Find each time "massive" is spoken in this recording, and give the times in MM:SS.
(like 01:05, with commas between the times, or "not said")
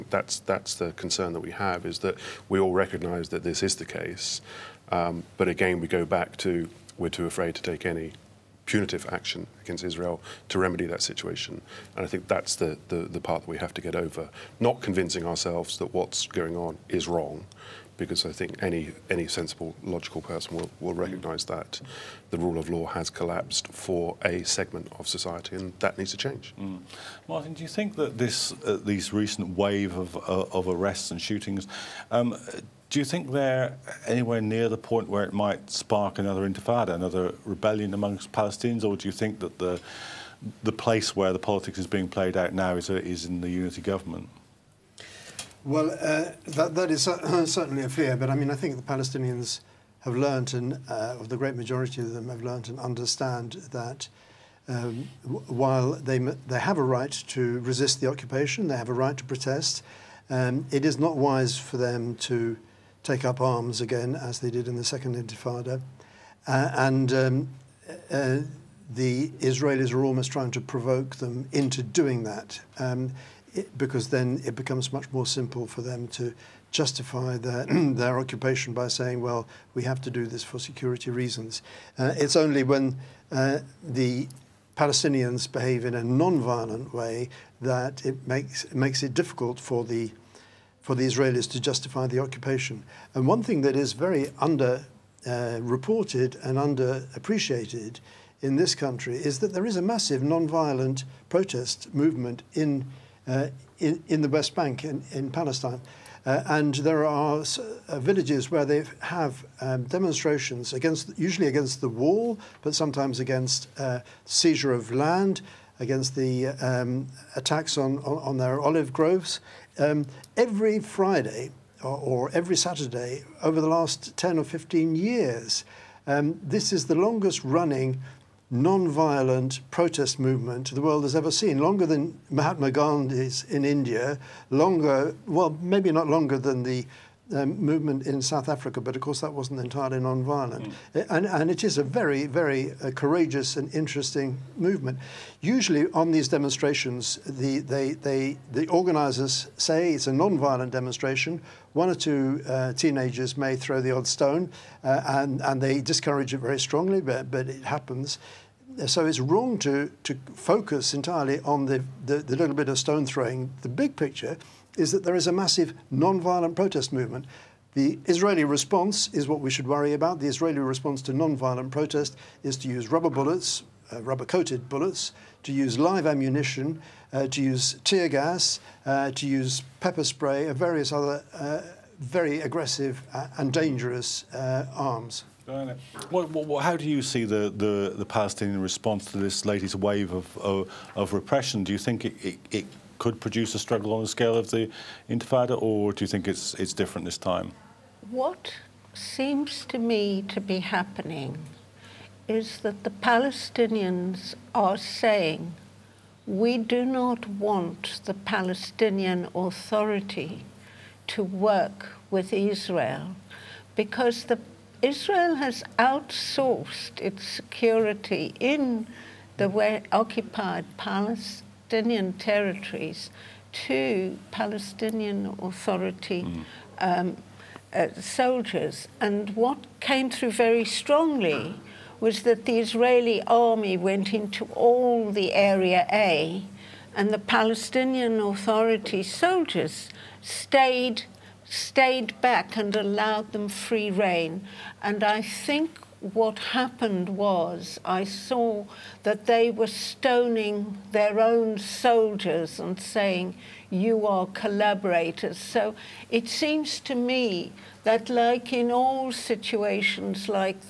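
01:39, 02:45.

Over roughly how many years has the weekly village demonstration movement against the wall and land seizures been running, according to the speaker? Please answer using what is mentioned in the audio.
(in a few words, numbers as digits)
10 or 15 years.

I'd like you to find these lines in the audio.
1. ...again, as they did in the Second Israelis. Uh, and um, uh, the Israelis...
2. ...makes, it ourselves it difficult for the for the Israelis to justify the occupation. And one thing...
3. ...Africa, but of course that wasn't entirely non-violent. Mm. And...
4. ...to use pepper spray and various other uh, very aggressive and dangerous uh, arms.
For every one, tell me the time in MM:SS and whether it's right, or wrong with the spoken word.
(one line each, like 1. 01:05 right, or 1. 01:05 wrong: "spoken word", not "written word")
1. 01:03 wrong: "Intifada", not "Israelis"
2. 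01:28 wrong: "makes", not "ourselves"
3. 02:18 right
4. 02:59 right.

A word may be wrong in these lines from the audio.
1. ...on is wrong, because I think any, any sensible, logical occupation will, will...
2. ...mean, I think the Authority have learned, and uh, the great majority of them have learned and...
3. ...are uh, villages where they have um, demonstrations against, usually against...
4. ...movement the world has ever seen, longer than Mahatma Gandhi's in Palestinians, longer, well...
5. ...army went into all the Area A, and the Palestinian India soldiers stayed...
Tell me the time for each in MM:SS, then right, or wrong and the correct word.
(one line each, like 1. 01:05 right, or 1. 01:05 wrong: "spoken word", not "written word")
1. 00:16 wrong: "person", not "occupation"
2. 00:48 wrong: "Palestinians", not "Authority"
3. 01:47 right
4. 02:10 wrong: "India", not "Palestinians"
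5. 03:53 wrong: "Authority", not "India".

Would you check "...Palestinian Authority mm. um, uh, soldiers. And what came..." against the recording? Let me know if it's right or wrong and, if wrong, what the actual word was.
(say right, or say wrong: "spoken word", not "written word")
right.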